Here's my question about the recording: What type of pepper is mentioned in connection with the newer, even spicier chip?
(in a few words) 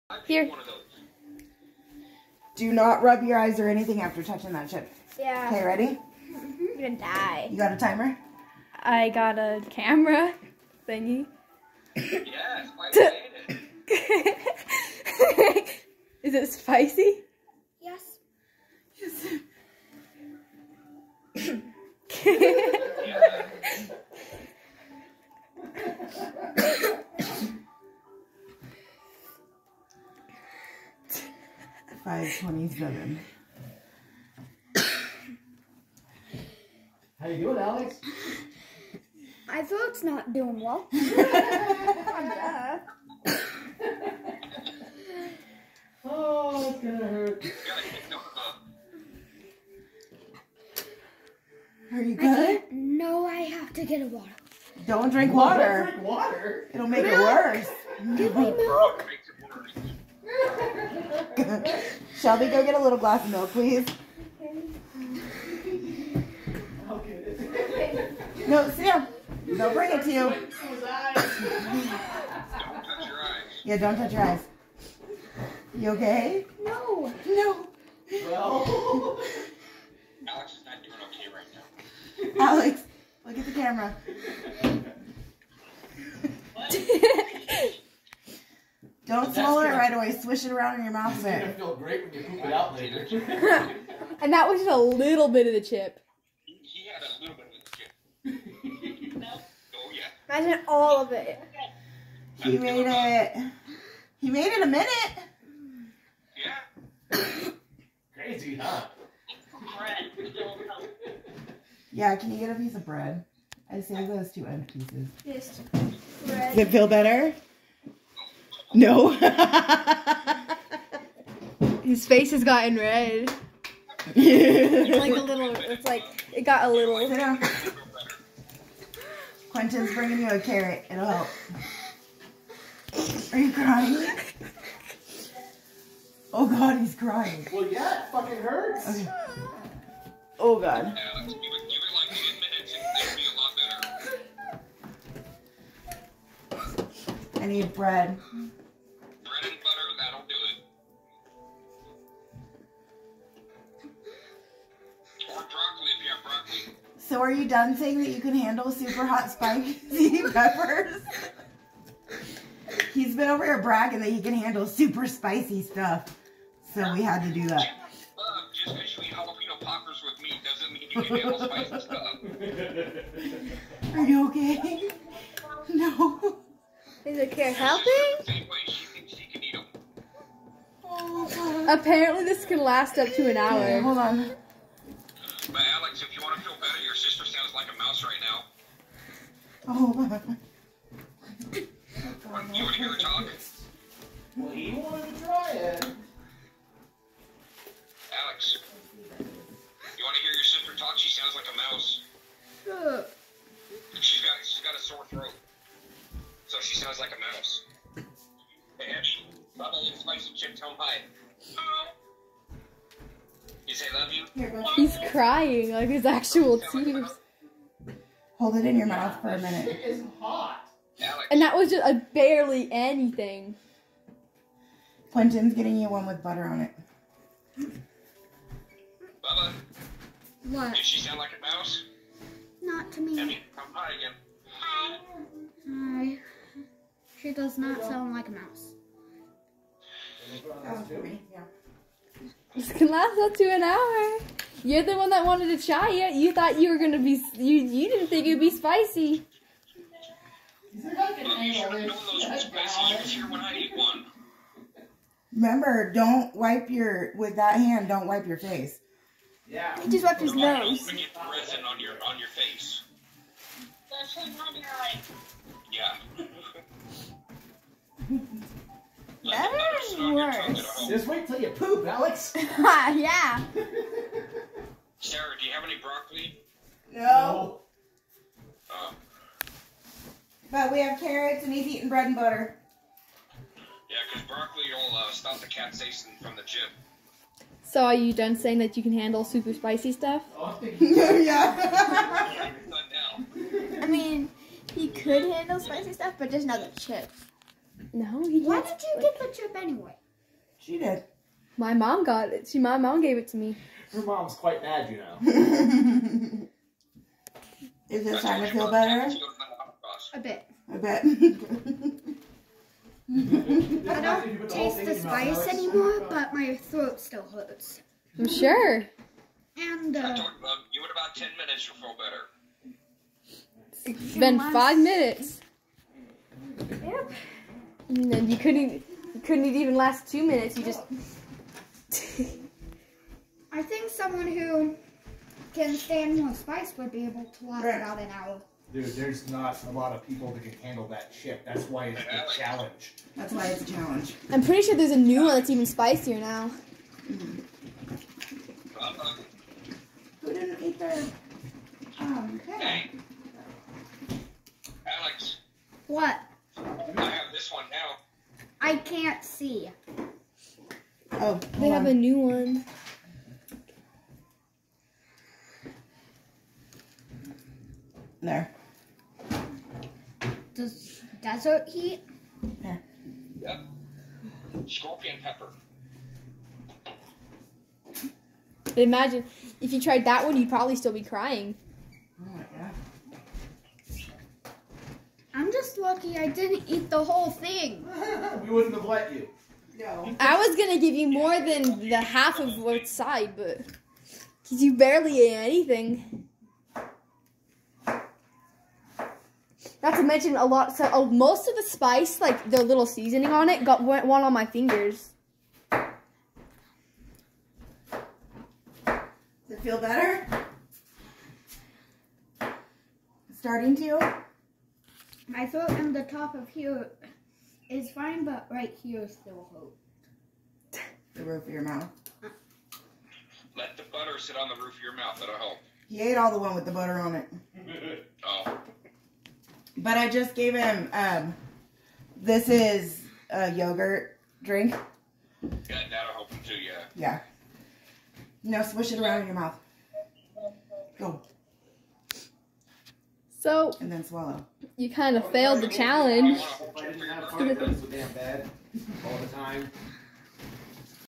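Scorpion pepper.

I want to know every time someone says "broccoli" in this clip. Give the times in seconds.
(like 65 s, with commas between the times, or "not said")
275 s, 284 s.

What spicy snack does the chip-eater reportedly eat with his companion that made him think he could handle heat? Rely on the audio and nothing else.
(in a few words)
Jalapeno poppers.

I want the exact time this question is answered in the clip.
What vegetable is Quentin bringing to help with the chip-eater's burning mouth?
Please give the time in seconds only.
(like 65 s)
130 s.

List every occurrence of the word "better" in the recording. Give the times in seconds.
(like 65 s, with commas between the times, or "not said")
116 s, 186 s, 308 s, 321 s, 409 s.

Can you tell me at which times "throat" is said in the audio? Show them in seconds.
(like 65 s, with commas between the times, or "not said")
39 s, 316 s, 415 s.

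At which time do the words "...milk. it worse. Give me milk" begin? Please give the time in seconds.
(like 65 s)
57 s.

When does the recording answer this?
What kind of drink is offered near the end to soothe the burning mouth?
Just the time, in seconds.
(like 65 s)
433 s.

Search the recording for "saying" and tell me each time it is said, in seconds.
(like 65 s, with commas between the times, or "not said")
157 s, 288 s.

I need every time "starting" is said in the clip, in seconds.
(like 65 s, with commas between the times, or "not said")
308 s, 413 s.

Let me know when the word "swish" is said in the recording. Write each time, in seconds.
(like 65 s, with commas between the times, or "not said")
90 s, 438 s.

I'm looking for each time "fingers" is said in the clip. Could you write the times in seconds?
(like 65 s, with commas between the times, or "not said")
404 s.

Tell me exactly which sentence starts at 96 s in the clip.
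He had a little bit of the chip.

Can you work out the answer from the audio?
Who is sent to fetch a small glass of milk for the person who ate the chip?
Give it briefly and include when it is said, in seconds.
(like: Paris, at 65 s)
Shelby, at 62 s.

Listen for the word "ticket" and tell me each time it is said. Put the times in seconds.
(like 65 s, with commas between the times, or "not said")
not said.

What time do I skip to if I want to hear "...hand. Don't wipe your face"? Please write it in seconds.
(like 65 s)
257 s.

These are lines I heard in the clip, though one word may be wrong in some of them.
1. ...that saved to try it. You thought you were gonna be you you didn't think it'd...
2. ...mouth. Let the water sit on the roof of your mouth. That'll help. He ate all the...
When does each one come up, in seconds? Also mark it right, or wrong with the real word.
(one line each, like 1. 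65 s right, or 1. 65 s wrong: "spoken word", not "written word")
1. 245 s wrong: "wanted", not "saved"
2. 421 s wrong: "butter", not "water".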